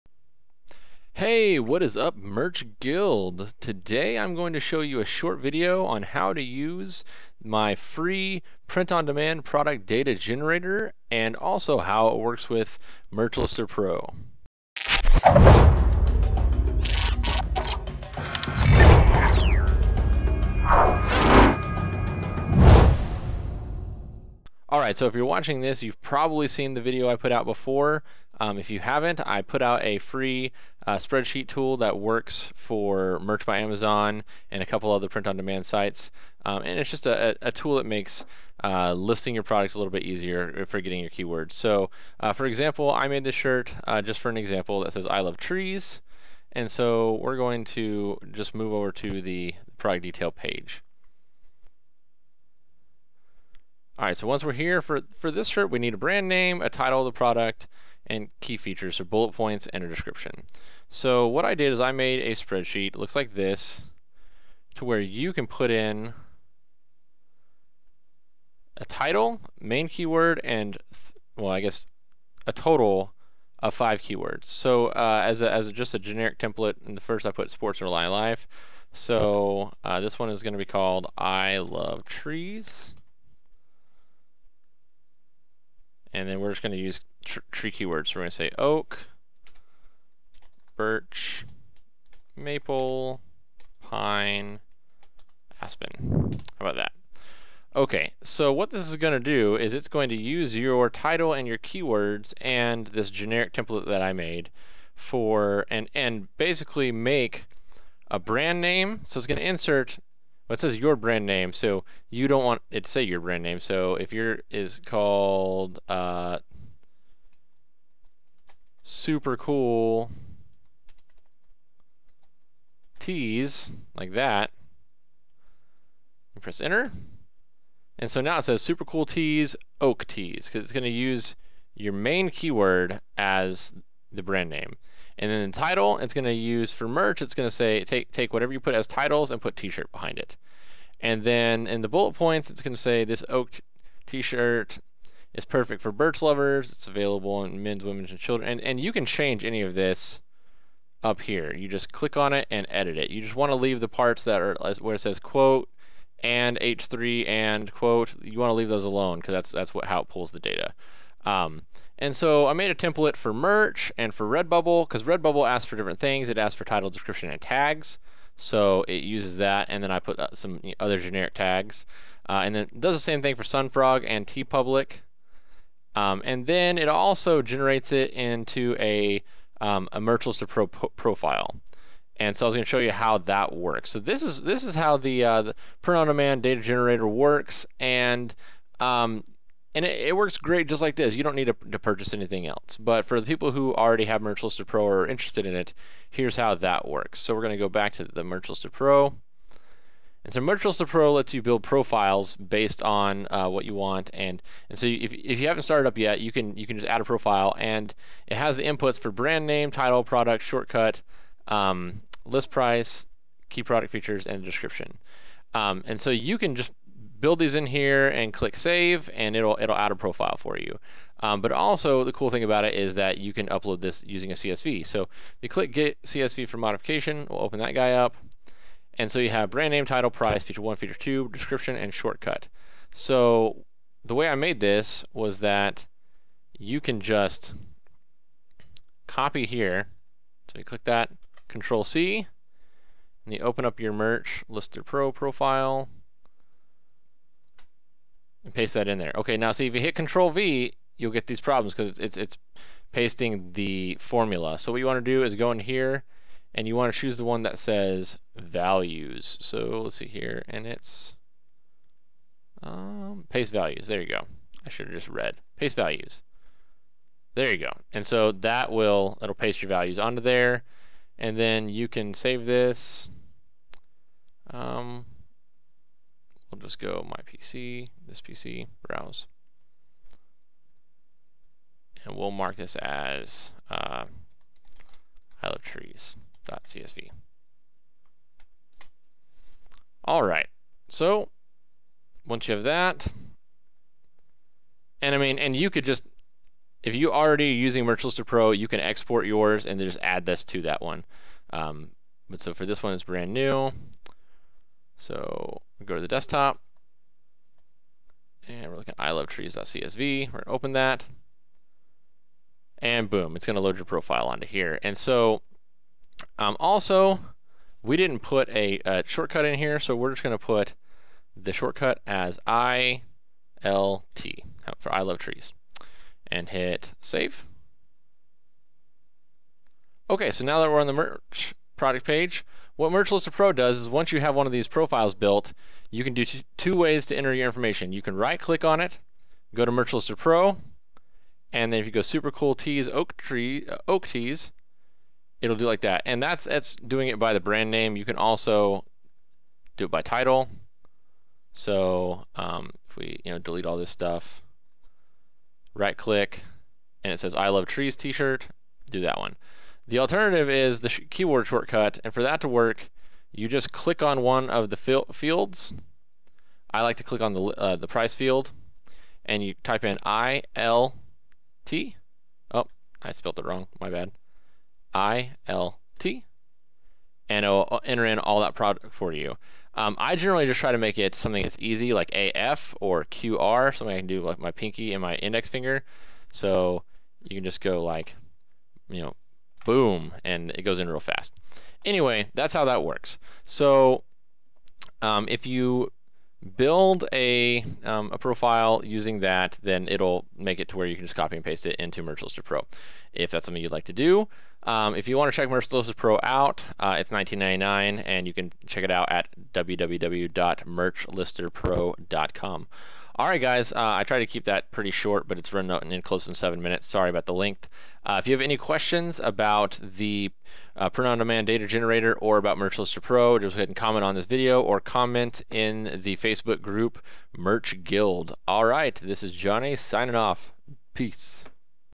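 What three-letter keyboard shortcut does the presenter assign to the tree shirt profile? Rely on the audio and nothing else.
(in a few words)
ILT.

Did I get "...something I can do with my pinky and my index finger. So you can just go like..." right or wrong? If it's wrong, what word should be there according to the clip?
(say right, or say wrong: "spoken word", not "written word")
right.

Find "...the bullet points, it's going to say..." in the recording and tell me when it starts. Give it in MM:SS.
02:21.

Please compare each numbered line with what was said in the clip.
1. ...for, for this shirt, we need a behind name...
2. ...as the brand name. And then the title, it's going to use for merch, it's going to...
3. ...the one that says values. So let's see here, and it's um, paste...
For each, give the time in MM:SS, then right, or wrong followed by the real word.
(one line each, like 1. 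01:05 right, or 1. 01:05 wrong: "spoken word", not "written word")
1. 00:54 wrong: "brand", not "behind"
2. 02:13 right
3. 04:17 right.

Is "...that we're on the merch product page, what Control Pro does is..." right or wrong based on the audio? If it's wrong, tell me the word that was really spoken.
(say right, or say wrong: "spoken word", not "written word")
wrong: "Merch", not "Control".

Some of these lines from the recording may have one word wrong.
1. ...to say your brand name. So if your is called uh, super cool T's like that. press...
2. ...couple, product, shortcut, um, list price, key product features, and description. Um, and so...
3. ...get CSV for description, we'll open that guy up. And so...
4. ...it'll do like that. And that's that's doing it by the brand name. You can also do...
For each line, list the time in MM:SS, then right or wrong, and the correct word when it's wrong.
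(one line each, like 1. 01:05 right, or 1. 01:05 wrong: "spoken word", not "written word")
1. 01:52 right
2. 03:29 wrong: "title", not "couple"
3. 03:45 wrong: "modification", not "description"
4. 05:45 right.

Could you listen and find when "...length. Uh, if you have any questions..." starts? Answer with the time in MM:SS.
06:57.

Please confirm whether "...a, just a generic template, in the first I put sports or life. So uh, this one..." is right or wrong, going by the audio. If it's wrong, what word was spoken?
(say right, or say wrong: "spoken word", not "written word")
right.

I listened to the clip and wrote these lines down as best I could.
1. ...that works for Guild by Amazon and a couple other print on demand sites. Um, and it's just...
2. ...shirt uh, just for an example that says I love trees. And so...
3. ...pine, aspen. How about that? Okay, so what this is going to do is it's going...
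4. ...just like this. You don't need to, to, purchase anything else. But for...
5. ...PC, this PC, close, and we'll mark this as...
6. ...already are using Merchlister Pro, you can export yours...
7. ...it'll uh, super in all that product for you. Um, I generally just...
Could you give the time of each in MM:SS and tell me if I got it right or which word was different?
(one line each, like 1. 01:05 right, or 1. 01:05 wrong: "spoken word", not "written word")
1. 00:31 wrong: "Merch", not "Guild"
2. 00:43 right
3. 01:33 right
4. 03:10 right
5. 04:37 wrong: "browse", not "close"
6. 04:57 right
7. 06:17 wrong: "enter", not "super".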